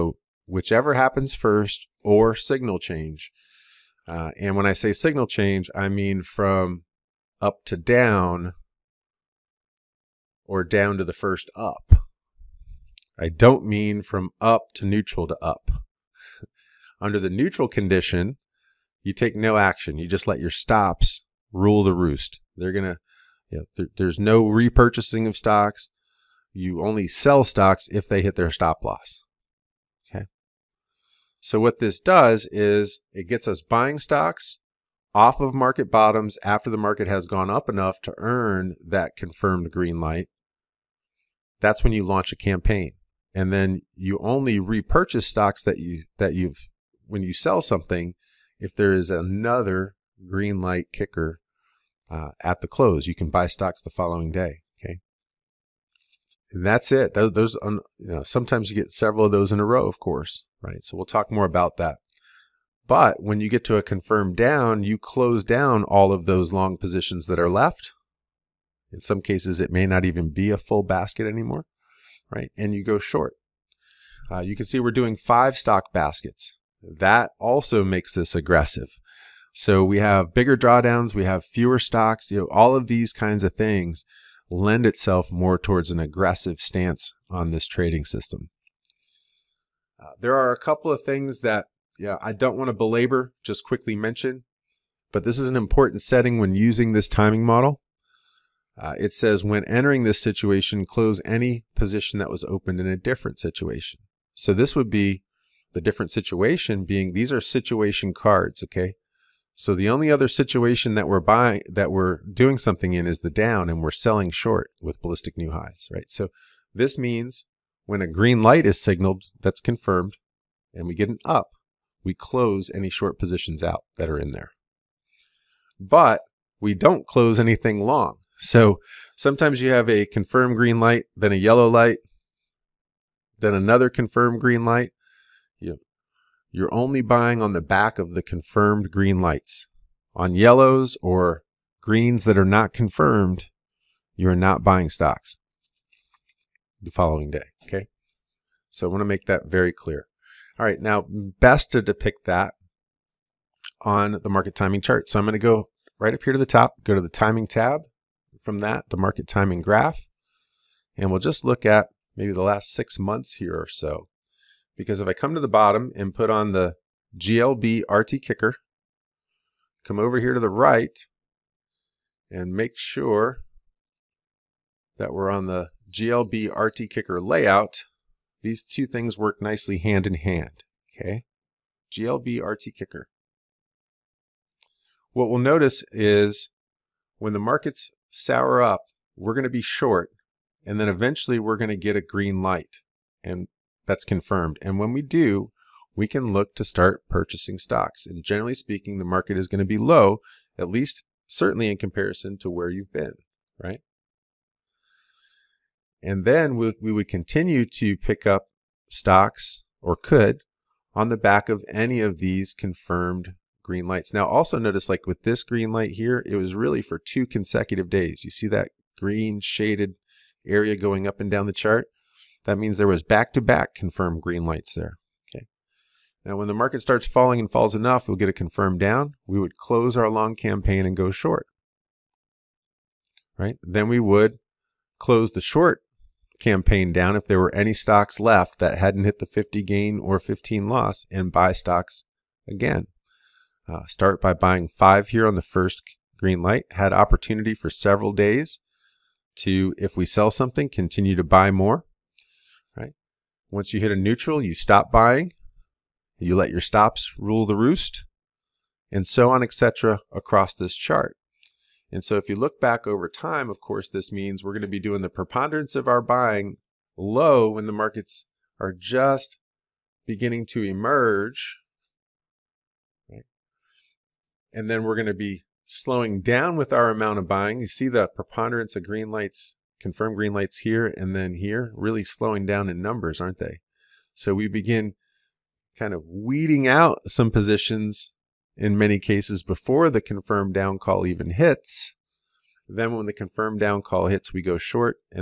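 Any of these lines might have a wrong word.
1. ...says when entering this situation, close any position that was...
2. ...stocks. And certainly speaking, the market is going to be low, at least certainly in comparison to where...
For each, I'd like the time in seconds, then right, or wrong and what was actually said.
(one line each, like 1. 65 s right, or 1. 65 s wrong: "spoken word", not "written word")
1. 99 s right
2. 197 s wrong: "generally", not "certainly".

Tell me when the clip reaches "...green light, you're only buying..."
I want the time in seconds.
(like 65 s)
134 s.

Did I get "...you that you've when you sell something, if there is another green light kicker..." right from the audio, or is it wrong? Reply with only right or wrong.
right.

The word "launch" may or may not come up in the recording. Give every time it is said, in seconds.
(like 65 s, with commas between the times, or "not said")
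42 s.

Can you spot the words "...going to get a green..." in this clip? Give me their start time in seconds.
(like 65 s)
191 s.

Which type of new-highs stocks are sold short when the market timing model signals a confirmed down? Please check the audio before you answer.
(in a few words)
Ballistic new highs.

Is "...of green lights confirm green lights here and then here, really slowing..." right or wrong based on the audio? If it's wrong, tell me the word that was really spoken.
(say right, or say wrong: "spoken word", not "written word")
right.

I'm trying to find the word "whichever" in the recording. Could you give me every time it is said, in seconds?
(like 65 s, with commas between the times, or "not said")
0 s.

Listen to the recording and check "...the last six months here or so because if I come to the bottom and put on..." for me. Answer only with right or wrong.
right.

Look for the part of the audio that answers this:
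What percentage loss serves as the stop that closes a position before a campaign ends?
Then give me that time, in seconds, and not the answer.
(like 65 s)
240 s.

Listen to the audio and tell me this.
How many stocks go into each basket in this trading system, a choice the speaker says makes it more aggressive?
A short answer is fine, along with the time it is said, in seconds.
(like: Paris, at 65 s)
5, at 75 s.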